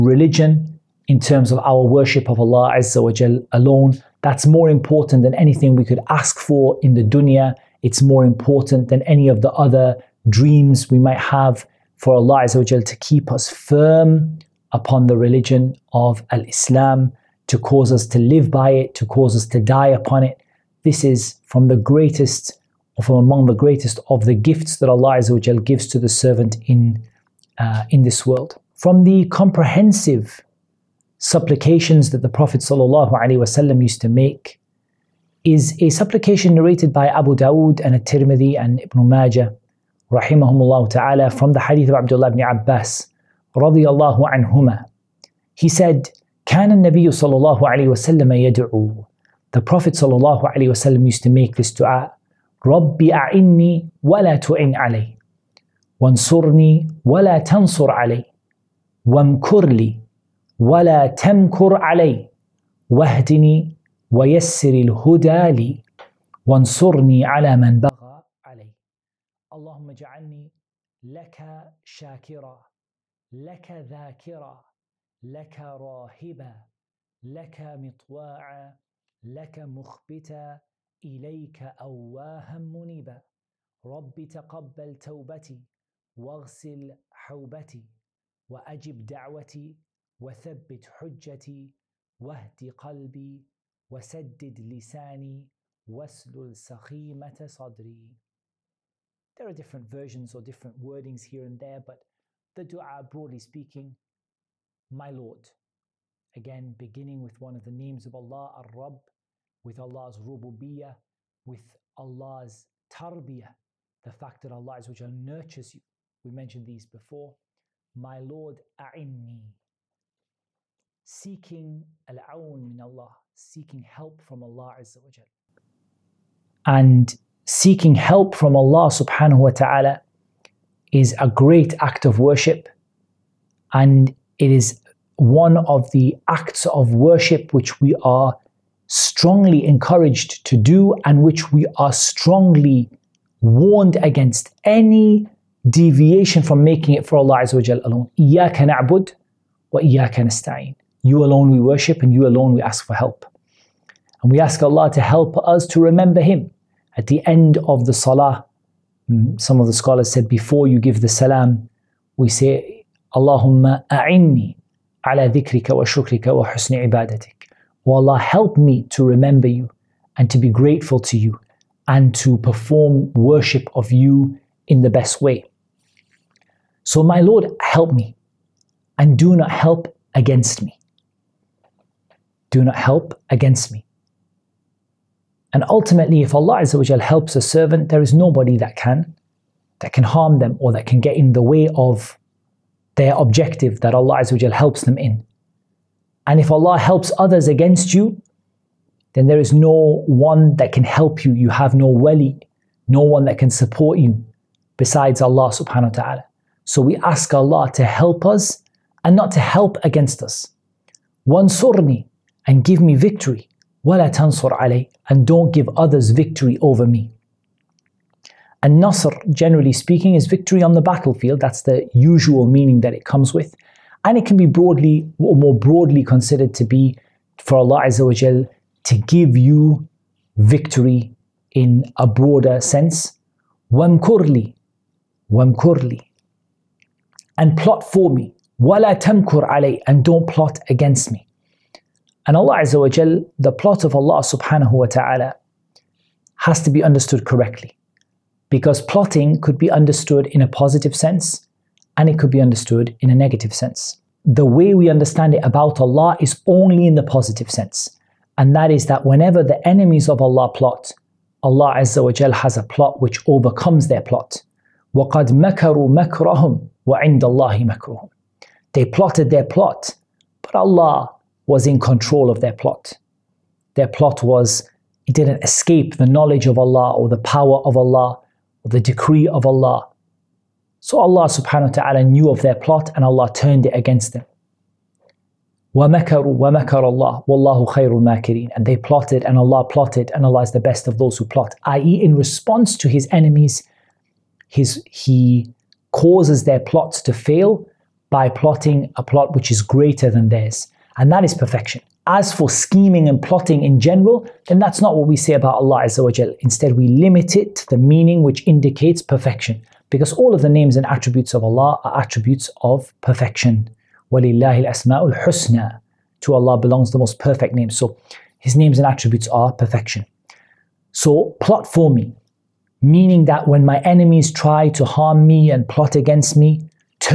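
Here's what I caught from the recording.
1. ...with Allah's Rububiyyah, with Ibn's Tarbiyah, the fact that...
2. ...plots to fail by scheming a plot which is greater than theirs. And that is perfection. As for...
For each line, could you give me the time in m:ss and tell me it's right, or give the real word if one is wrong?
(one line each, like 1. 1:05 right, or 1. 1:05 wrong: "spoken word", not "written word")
1. 1:49 wrong: "Allah", not "Ibn"
2. 4:56 wrong: "plotting", not "scheming".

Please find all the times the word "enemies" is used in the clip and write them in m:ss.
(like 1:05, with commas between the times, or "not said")
4:19, 4:53, 5:23.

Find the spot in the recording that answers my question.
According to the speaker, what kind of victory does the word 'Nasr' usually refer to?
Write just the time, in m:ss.
3:40.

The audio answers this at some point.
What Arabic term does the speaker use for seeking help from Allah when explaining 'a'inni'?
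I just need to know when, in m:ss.
2:02.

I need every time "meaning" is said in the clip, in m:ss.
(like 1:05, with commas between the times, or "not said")
3:42, 5:07, 5:22.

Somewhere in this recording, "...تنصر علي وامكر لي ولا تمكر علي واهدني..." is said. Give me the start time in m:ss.
0:57.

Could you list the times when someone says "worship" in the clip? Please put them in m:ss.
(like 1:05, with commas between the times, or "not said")
0:01, 2:12, 2:16, 2:31, 2:53.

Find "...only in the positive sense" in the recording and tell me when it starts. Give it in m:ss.
4:16.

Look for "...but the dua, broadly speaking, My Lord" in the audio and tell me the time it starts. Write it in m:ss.
1:41.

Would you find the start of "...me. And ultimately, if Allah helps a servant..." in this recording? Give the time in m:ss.
3:03.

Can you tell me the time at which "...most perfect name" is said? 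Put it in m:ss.
5:16.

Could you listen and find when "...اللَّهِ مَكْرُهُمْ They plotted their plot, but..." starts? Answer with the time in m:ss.
4:27.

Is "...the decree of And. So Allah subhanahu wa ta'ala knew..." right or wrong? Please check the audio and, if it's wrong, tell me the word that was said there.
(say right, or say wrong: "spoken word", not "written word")
wrong: "Allah", not "And".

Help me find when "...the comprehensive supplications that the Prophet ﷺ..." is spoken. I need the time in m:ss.
0:29.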